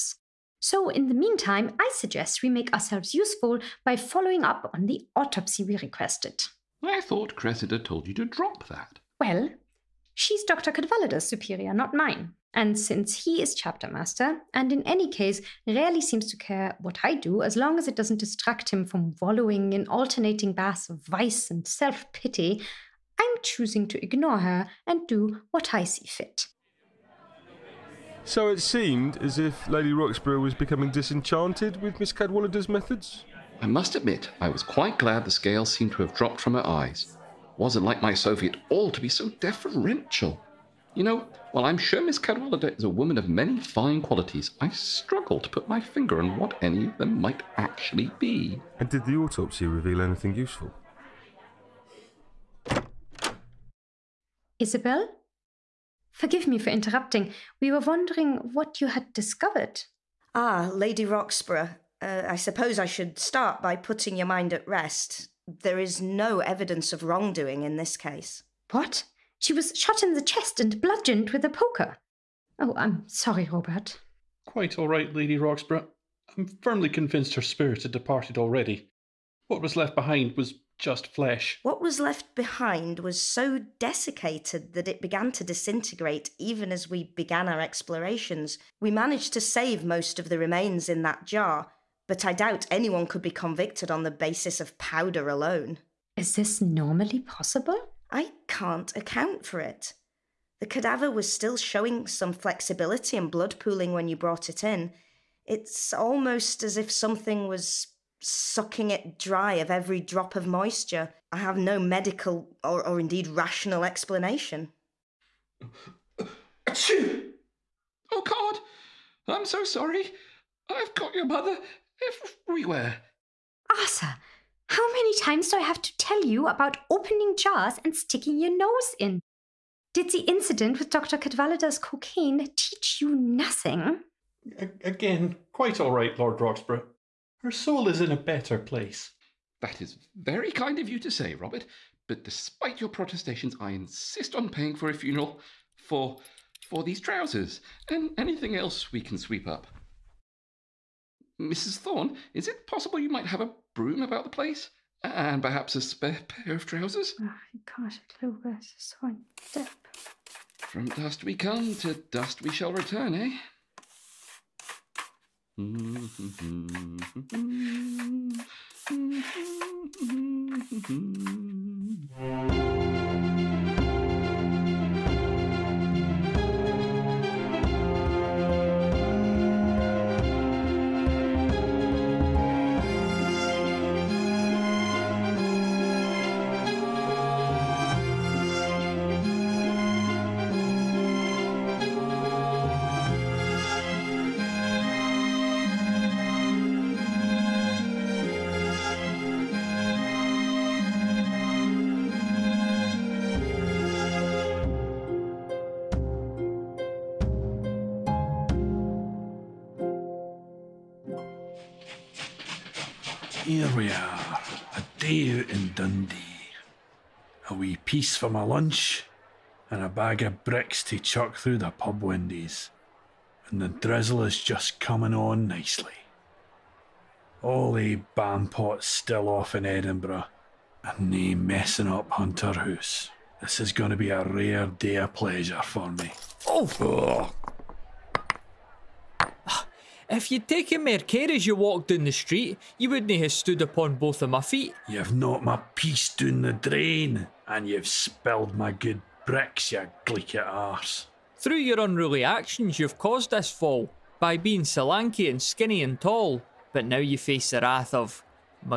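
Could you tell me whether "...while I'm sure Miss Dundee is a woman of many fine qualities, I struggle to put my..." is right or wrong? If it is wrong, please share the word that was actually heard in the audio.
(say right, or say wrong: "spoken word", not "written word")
wrong: "Cadwallader", not "Dundee".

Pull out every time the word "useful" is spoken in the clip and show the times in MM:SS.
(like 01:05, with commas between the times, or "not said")
00:03, 00:50.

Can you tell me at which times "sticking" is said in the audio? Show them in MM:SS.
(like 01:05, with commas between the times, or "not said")
02:07.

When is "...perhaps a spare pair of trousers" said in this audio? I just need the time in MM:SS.
02:35.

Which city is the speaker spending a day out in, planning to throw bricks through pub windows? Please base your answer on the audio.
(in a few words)
Dundee.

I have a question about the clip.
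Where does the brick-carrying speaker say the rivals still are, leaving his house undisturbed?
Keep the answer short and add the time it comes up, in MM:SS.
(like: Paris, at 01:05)
Edinburgh, at 03:49.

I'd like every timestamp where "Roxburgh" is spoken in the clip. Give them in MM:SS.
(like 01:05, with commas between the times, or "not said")
00:29, 01:01, 01:15, 02:16.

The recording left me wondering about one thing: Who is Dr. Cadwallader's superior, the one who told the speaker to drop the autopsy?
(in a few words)
Cressida.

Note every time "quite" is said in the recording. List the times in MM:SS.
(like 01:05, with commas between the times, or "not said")
00:34, 01:14, 02:15.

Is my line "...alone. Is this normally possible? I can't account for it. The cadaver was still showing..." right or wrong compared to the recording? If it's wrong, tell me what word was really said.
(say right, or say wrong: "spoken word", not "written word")
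right.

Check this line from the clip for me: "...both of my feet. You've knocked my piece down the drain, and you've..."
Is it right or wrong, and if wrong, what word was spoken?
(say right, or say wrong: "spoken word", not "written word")
right.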